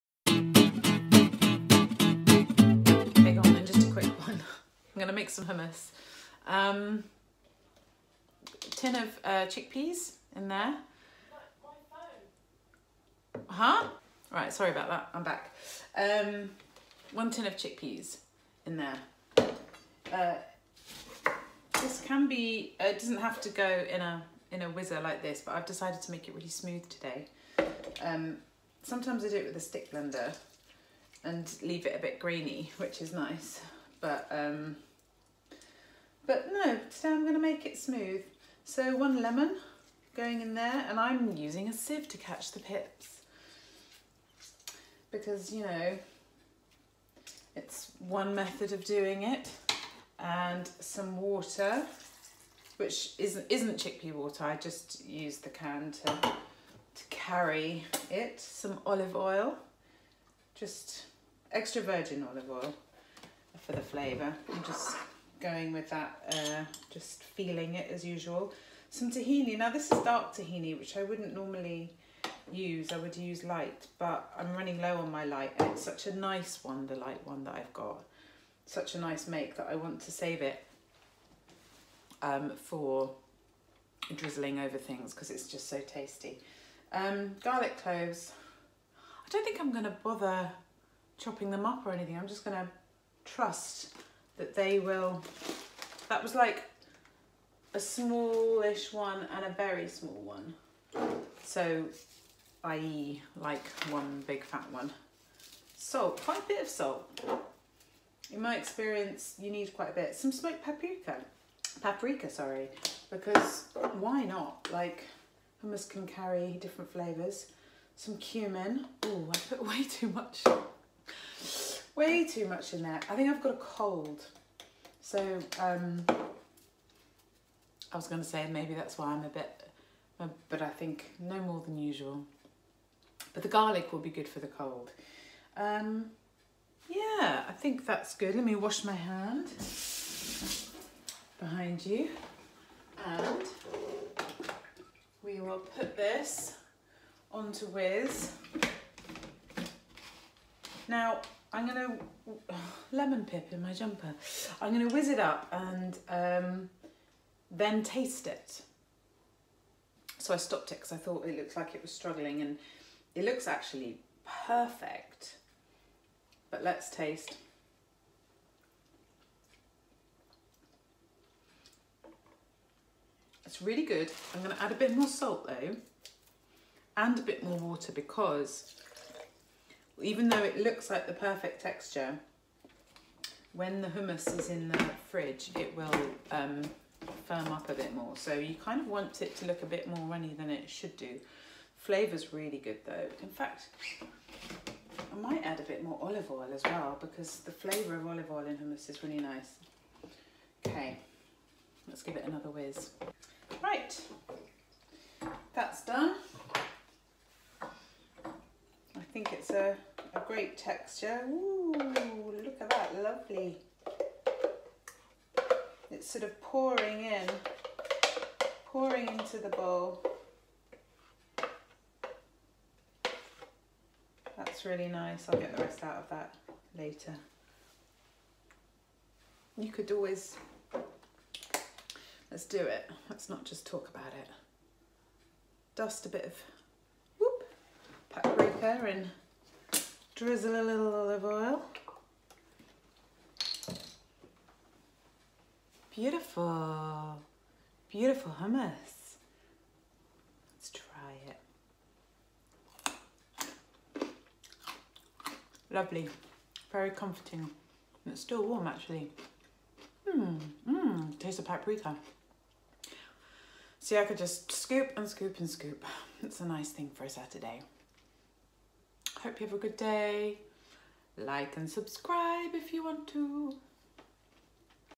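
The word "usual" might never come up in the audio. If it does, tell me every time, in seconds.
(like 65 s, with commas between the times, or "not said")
68 s, 131 s.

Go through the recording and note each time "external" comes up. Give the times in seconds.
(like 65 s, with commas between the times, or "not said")
not said.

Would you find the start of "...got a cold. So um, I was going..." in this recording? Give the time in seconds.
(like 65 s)
123 s.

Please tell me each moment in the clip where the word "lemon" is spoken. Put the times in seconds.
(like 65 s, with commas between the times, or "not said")
39 s, 152 s.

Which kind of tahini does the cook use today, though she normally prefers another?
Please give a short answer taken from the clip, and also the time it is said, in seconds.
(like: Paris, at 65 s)
dark, at 70 s.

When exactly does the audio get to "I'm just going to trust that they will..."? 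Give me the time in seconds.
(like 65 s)
92 s.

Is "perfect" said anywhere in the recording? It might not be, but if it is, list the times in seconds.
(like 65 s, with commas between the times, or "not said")
164 s, 181 s.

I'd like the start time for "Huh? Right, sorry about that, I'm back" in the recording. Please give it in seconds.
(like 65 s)
13 s.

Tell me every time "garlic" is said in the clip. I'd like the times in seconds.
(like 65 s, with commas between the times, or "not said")
87 s, 133 s.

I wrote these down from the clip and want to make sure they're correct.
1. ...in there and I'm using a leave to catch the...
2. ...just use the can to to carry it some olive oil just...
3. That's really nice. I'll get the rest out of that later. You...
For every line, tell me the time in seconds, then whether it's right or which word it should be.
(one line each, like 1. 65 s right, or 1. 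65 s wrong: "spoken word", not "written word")
1. 40 s wrong: "sieve", not "leave"
2. 54 s right
3. 224 s right.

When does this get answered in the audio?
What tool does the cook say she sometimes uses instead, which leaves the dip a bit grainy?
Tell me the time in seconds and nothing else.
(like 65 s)
29 s.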